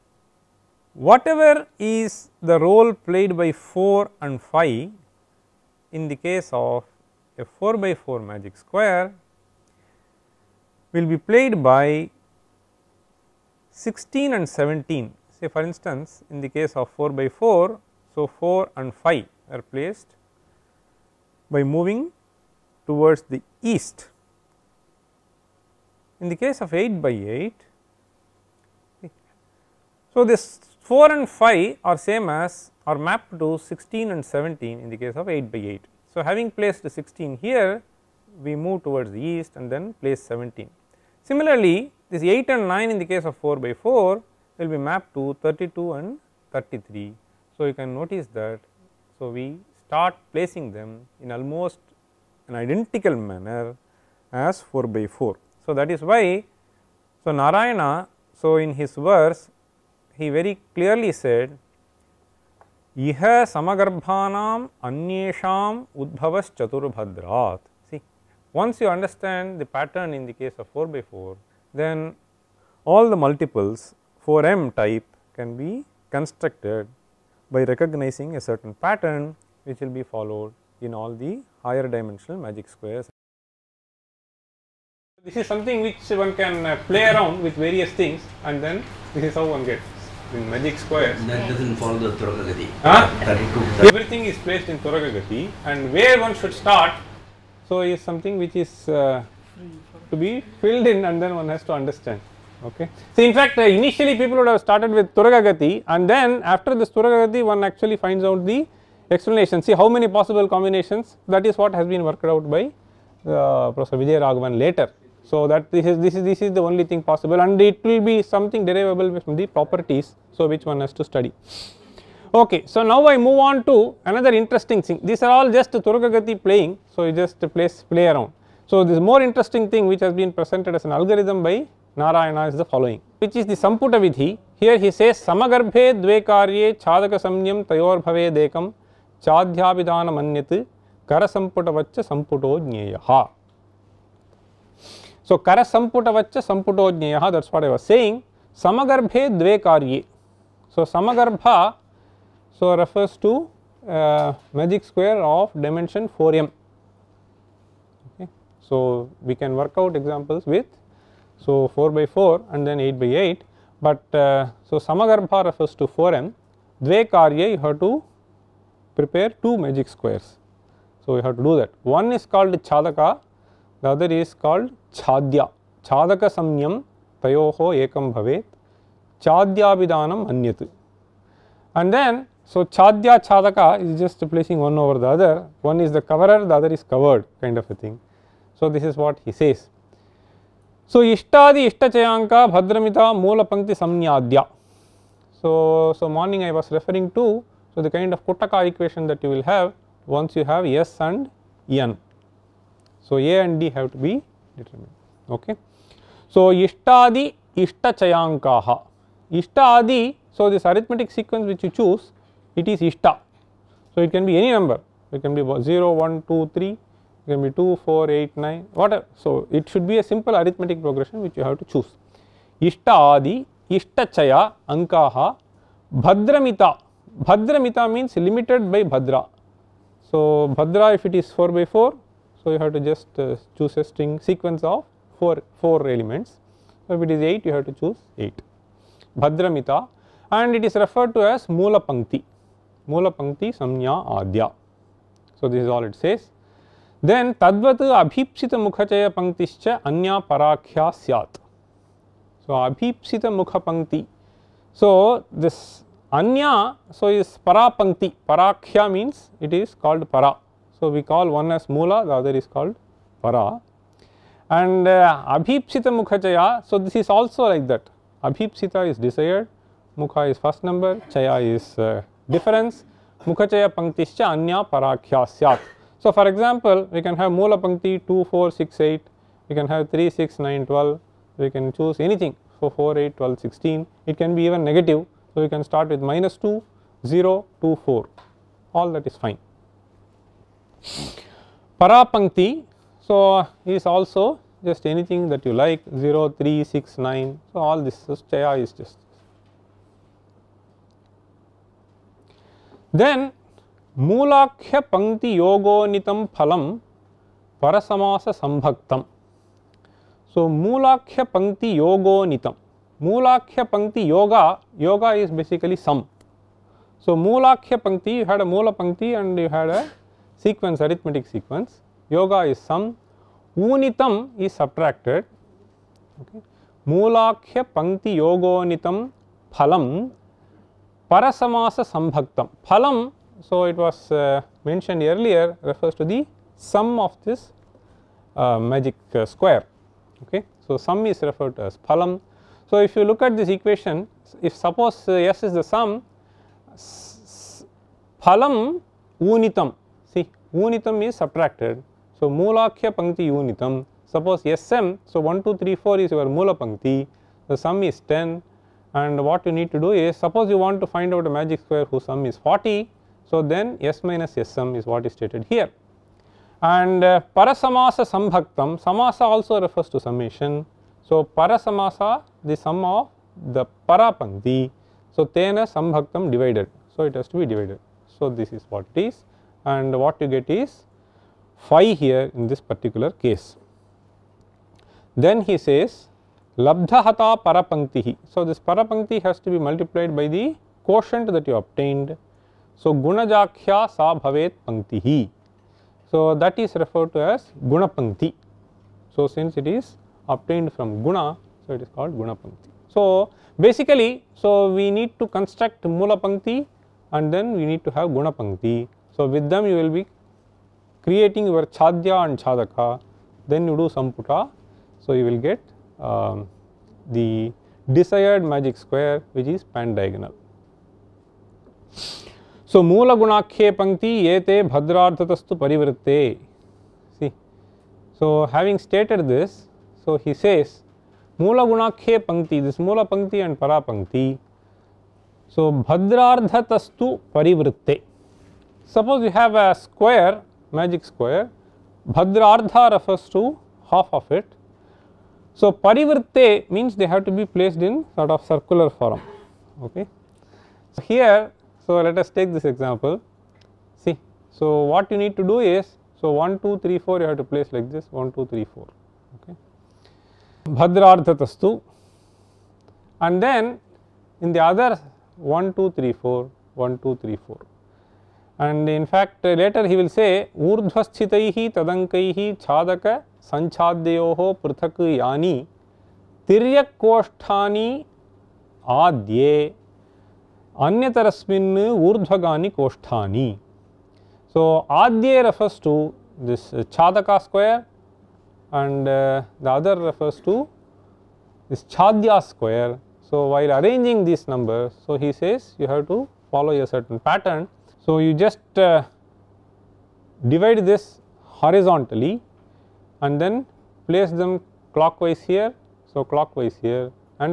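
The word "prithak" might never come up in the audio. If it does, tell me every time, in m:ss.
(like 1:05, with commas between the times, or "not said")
7:54.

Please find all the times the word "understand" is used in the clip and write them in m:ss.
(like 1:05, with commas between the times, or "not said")
1:08, 1:41.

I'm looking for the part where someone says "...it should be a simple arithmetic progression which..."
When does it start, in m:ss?
3:39.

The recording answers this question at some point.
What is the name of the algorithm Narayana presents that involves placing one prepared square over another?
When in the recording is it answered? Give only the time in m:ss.
2:13.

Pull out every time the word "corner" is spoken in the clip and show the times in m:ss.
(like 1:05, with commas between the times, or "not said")
not said.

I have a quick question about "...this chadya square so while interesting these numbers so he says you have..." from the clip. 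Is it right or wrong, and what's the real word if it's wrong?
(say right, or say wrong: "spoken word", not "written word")
wrong: "arranging", not "interesting".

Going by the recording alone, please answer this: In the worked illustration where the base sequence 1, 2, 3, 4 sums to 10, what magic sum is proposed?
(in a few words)
40.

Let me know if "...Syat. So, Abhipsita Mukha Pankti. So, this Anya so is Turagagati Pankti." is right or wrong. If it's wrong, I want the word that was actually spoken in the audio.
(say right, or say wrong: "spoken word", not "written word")
wrong: "Para", not "Turagagati".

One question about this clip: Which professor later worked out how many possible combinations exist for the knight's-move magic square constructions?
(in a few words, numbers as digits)
Professor Vijay Raghavan.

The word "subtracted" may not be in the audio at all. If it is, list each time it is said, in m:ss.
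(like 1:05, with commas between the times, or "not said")
5:24, 5:51.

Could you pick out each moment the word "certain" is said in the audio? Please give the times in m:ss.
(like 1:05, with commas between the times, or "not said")
1:18, 8:16.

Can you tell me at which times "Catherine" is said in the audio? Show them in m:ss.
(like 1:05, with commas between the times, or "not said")
not said.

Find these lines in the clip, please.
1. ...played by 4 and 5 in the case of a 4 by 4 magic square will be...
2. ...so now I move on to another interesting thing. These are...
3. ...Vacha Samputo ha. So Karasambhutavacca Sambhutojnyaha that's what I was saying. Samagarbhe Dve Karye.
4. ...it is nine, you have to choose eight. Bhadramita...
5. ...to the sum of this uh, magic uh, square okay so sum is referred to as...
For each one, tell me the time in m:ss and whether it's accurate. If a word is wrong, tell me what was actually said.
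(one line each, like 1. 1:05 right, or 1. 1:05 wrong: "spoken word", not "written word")
1. 0:02 right
2. 2:02 right
3. 2:21 right
4. 3:57 wrong: "eight", not "nine"
5. 5:36 right.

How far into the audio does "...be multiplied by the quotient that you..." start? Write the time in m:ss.
6:29.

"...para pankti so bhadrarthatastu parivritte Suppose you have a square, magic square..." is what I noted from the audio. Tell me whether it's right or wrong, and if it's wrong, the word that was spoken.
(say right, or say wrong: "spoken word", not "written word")
right.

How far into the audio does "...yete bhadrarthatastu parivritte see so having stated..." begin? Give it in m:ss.
7:04.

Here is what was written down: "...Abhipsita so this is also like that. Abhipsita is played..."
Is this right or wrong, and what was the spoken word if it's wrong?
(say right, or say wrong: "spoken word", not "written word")
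wrong: "desired", not "played".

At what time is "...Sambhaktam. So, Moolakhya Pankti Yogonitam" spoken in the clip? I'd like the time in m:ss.
5:08.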